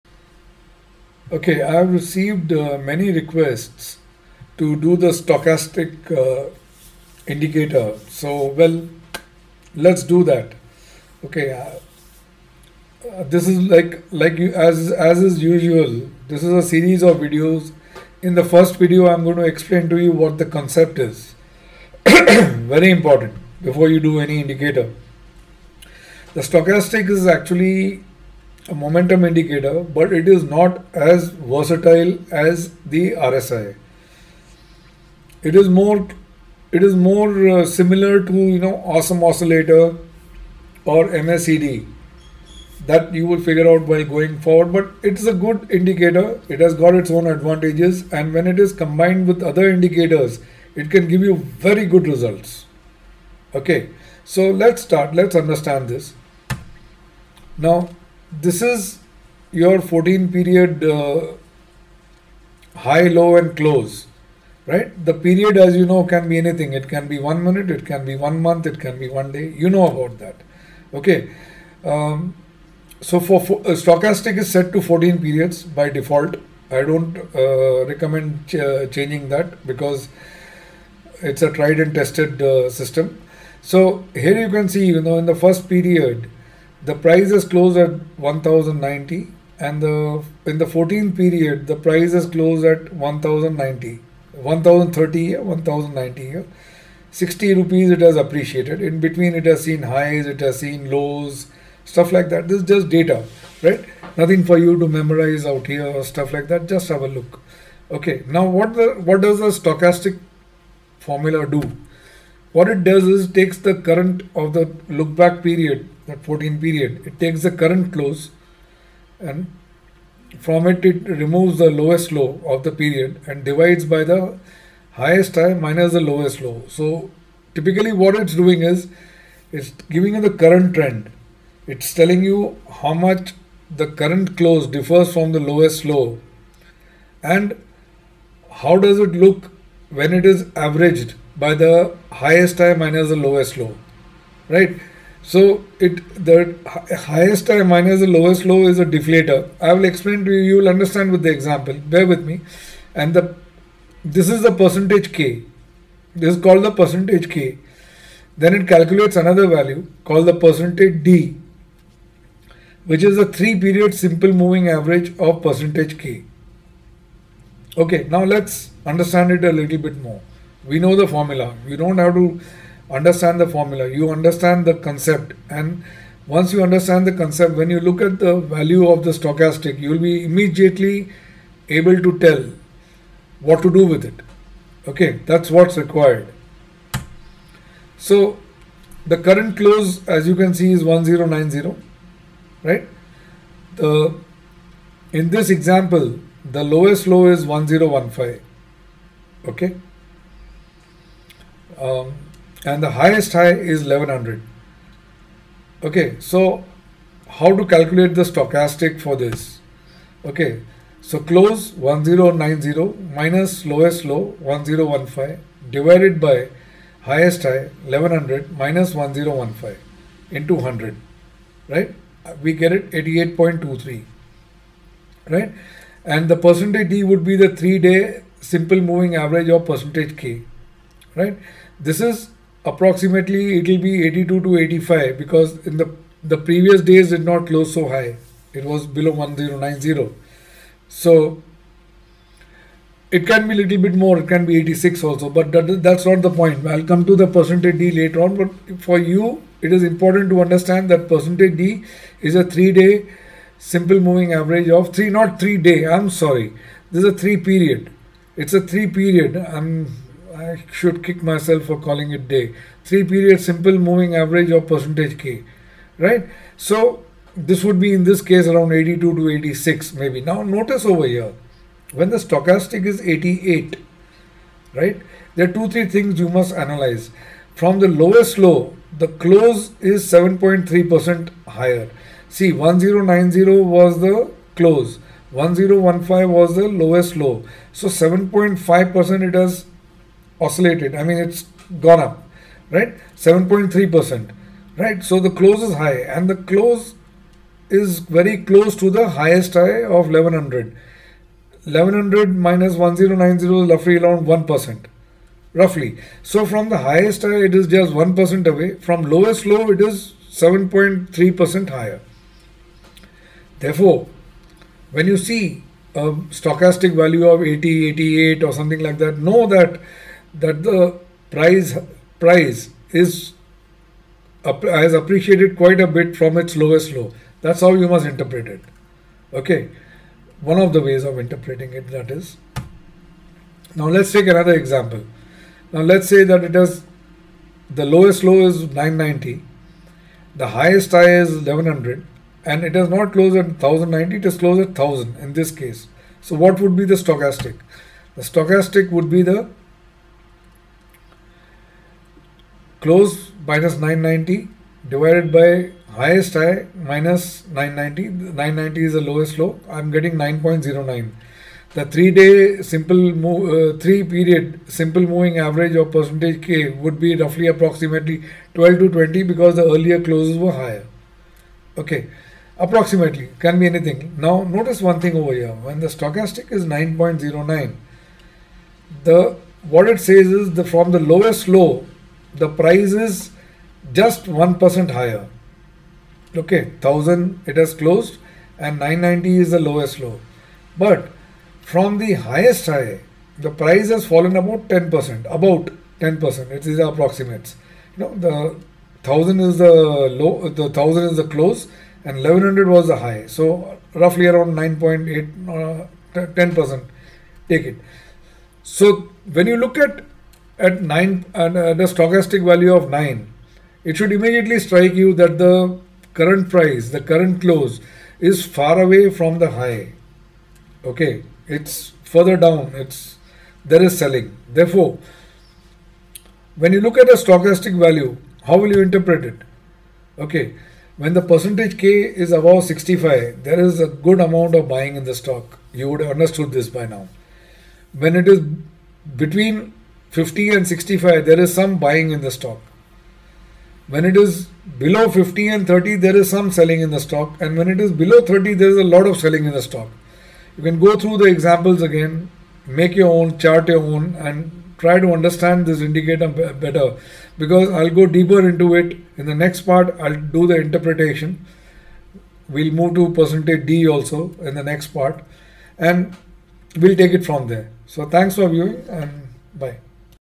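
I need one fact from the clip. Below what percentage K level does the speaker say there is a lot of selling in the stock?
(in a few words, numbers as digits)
30.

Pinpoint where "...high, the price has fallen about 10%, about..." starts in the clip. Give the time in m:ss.
6:32.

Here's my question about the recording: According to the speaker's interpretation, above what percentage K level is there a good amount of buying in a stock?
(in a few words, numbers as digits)
65.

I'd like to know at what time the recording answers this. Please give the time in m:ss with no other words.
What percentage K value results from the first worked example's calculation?
3:42.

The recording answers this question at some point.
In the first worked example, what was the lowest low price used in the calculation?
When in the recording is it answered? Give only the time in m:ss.
3:16.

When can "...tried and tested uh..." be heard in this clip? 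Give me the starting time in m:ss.
1:21.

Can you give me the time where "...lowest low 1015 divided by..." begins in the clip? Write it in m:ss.
3:33.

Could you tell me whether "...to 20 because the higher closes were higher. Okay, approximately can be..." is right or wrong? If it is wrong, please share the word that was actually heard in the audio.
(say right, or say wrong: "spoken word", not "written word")
wrong: "earlier", not "higher".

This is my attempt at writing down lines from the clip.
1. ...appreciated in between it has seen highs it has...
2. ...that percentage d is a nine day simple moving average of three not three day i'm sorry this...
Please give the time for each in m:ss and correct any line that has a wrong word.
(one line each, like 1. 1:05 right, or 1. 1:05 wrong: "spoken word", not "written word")
1. 1:38 right
2. 4:10 wrong: "three", not "nine".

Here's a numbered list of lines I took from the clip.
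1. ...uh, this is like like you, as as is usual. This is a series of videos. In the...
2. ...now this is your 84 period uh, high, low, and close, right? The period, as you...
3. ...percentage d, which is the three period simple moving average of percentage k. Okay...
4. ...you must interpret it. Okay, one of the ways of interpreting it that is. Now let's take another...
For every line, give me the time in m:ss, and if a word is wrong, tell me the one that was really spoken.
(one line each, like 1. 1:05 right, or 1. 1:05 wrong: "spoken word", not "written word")
1. 0:13 right
2. 0:57 wrong: "14", not "84"
3. 2:40 right
4. 5:27 right.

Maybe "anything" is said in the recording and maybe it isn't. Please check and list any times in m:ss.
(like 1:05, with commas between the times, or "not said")
1:06, 6:13.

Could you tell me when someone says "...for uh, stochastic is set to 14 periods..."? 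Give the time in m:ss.
1:13.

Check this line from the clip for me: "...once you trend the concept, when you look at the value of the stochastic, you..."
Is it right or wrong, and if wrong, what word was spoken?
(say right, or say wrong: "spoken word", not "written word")
wrong: "understand", not "trend".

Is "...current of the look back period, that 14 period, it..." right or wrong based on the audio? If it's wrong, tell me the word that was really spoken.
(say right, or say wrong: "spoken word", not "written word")
right.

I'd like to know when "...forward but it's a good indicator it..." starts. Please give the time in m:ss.
0:44.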